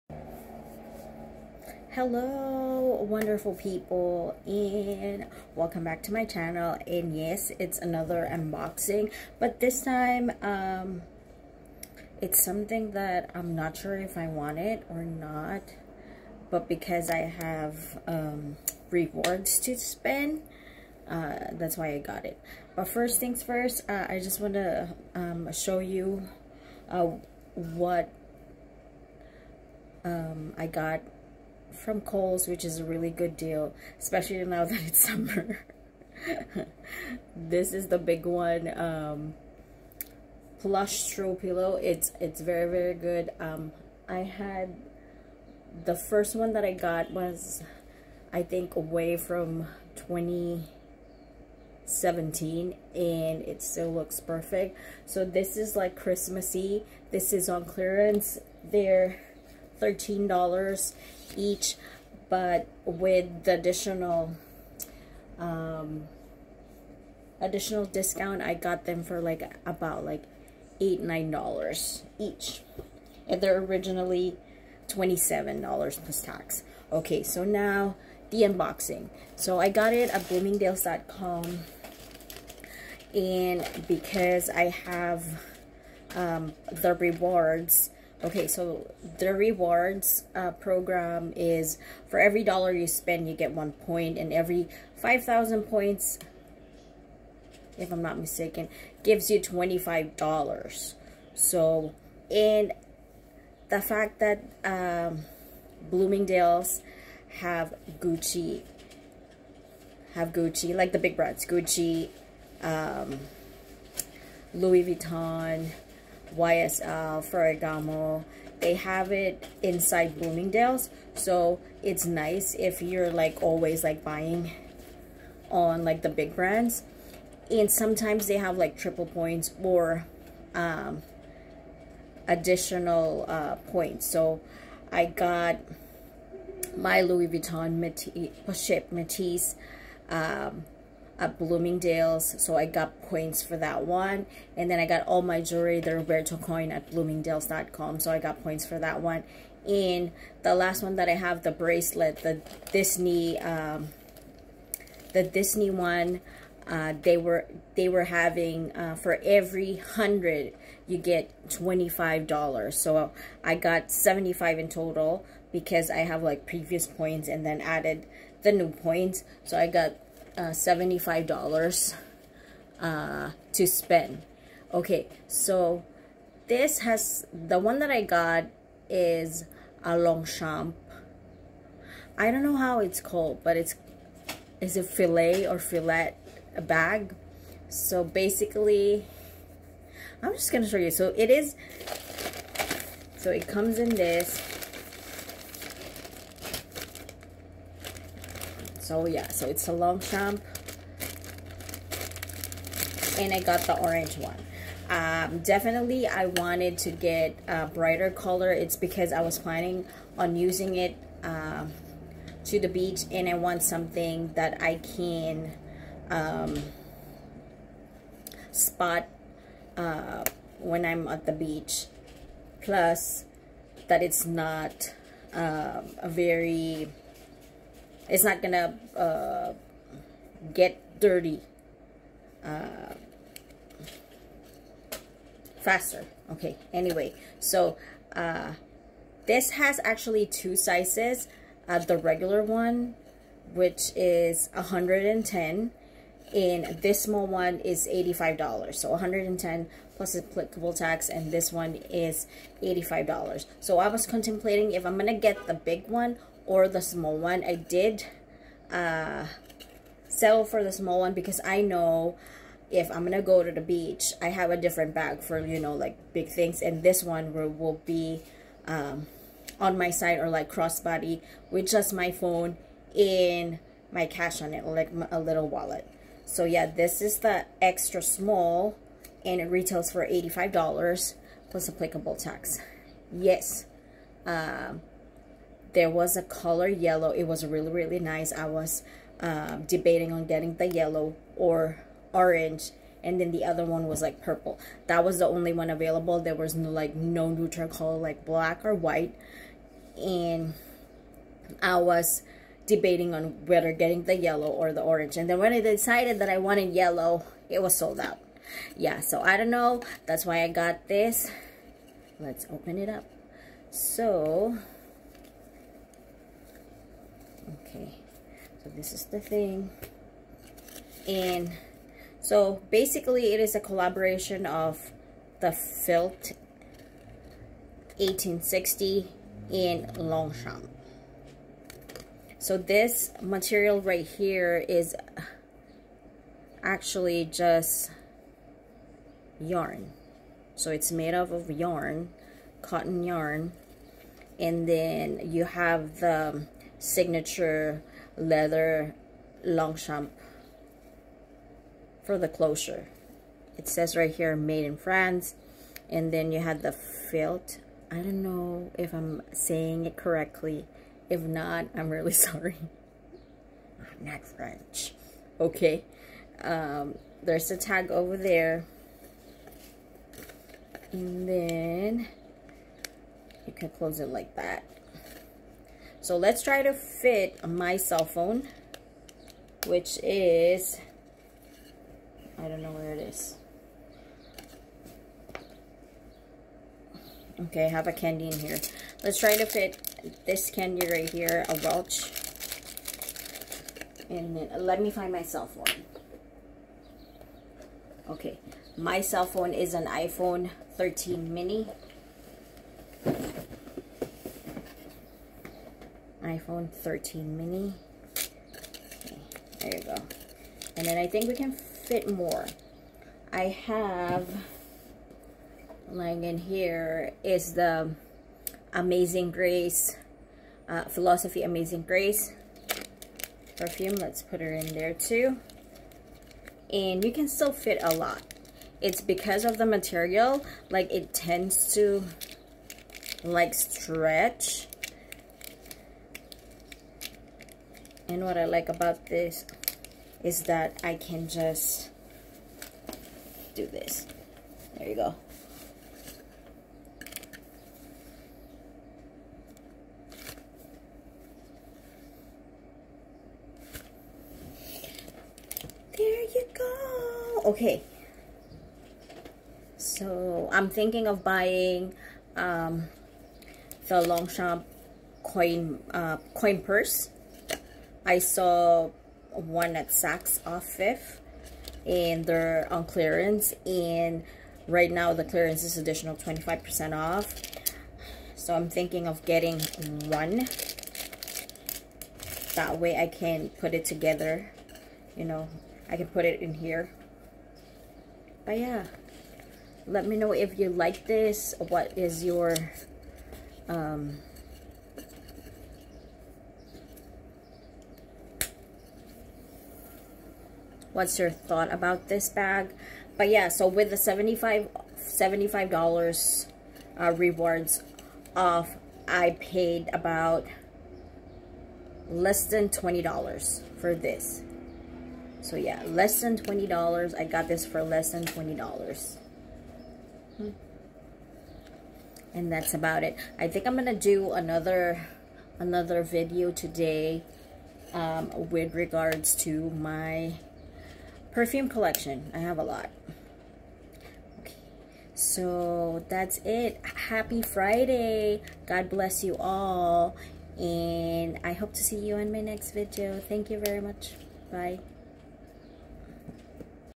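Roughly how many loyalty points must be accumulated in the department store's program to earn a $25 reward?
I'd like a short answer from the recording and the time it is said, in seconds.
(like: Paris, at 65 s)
5,000, at 94 s.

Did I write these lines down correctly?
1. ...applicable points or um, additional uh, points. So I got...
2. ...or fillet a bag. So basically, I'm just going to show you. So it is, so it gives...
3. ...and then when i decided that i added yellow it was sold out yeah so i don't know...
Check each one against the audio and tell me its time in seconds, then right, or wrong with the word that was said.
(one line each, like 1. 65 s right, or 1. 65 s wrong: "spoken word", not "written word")
1. 128 s wrong: "triple", not "applicable"
2. 185 s wrong: "comes", not "gives"
3. 305 s wrong: "wanted", not "added".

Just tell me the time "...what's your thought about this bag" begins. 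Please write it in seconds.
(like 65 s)
500 s.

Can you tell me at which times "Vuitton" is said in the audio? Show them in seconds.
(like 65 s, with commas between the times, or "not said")
114 s, 137 s.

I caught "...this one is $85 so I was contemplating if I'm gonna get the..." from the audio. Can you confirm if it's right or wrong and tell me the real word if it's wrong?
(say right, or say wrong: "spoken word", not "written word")
right.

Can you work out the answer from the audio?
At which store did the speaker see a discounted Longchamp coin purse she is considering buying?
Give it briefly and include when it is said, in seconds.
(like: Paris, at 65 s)
Saks Off Fifth, at 469 s.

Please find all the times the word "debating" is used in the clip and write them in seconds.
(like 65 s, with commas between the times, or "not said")
289 s, 302 s.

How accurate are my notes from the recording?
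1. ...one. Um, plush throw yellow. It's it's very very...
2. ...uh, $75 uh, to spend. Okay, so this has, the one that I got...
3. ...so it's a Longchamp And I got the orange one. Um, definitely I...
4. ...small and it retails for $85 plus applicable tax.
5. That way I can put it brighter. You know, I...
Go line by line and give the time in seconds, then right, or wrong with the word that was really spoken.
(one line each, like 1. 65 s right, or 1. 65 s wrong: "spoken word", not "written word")
1. 38 s wrong: "pillow", not "yellow"
2. 170 s right
3. 199 s right
4. 278 s right
5. 482 s wrong: "together", not "brighter".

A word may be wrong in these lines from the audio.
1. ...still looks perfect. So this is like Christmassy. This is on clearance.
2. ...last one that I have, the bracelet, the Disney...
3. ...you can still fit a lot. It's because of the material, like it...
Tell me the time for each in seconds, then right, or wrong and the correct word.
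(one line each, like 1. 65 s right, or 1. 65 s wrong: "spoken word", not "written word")
1. 53 s right
2. 150 s right
3. 427 s right.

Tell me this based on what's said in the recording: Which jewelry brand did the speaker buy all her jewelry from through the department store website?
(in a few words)
Roberto Coin.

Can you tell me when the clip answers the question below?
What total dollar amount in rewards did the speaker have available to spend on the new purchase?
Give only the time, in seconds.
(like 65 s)
163 s.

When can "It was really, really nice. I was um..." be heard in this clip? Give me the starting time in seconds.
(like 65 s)
287 s.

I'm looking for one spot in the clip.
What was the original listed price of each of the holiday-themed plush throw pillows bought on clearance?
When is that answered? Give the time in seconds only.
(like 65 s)
74 s.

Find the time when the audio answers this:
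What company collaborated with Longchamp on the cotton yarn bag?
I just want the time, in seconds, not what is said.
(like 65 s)
325 s.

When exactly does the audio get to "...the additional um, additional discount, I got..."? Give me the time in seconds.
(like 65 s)
63 s.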